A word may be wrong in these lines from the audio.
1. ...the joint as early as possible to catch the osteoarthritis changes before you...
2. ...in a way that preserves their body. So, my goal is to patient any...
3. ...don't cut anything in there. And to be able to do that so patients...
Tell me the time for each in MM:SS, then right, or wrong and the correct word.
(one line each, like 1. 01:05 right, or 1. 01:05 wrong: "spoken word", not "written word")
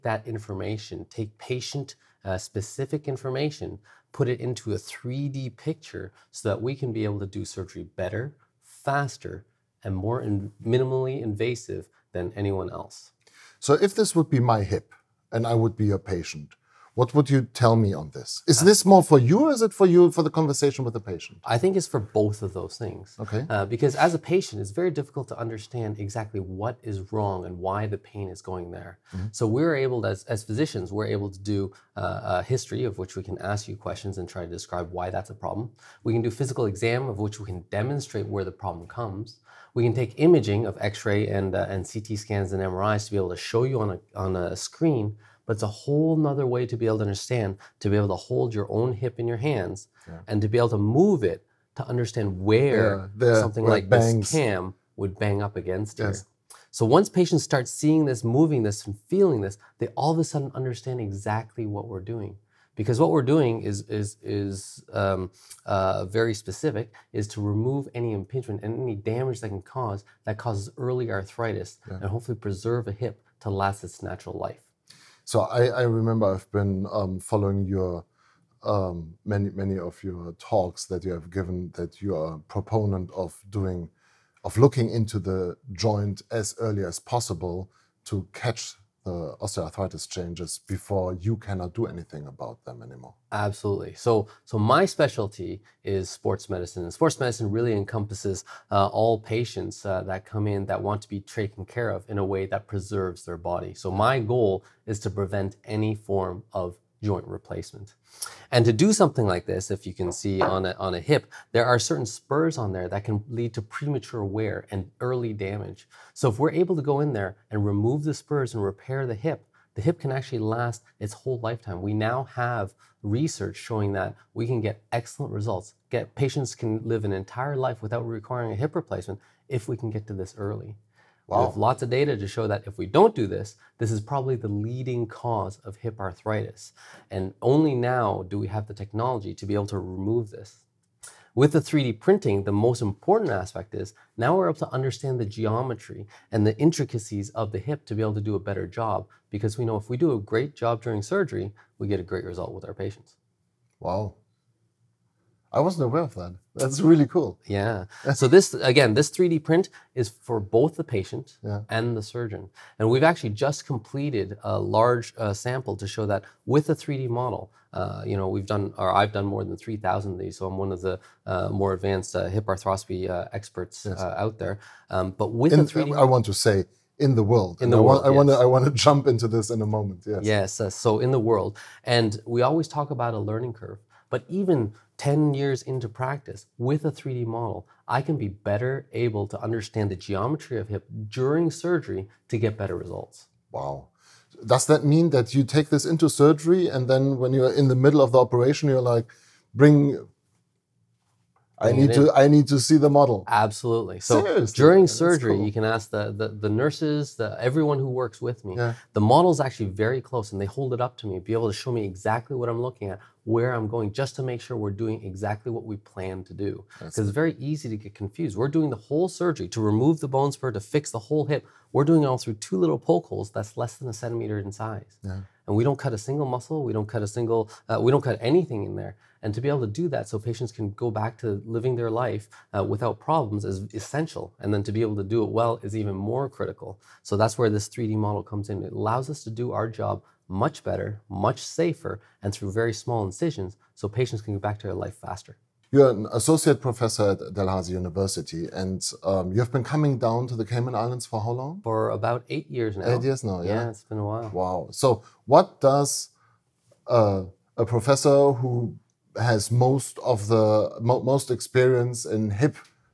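1. 01:25 right
2. 01:42 wrong: "prevent", not "patient"
3. 03:47 right.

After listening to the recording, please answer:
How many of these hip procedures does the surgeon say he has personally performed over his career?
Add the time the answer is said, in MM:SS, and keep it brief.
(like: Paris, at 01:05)
more than 3,000, at 02:49.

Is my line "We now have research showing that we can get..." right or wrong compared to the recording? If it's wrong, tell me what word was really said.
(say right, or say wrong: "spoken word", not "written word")
right.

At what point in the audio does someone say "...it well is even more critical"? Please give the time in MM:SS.
03:55.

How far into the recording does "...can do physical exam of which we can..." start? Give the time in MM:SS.
00:36.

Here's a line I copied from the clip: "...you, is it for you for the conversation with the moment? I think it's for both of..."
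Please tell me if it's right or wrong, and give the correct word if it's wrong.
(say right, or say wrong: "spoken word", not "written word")
wrong: "patient", not "moment".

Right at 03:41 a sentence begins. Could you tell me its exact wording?
We're doing it all through two little poke holes that's less than a centimeter in size.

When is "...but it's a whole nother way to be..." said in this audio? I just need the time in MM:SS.
00:45.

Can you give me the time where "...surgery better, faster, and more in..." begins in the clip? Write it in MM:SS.
00:07.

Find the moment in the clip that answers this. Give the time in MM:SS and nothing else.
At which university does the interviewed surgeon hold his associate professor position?
04:07.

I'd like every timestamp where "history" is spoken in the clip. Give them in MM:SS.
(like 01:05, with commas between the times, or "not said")
00:32.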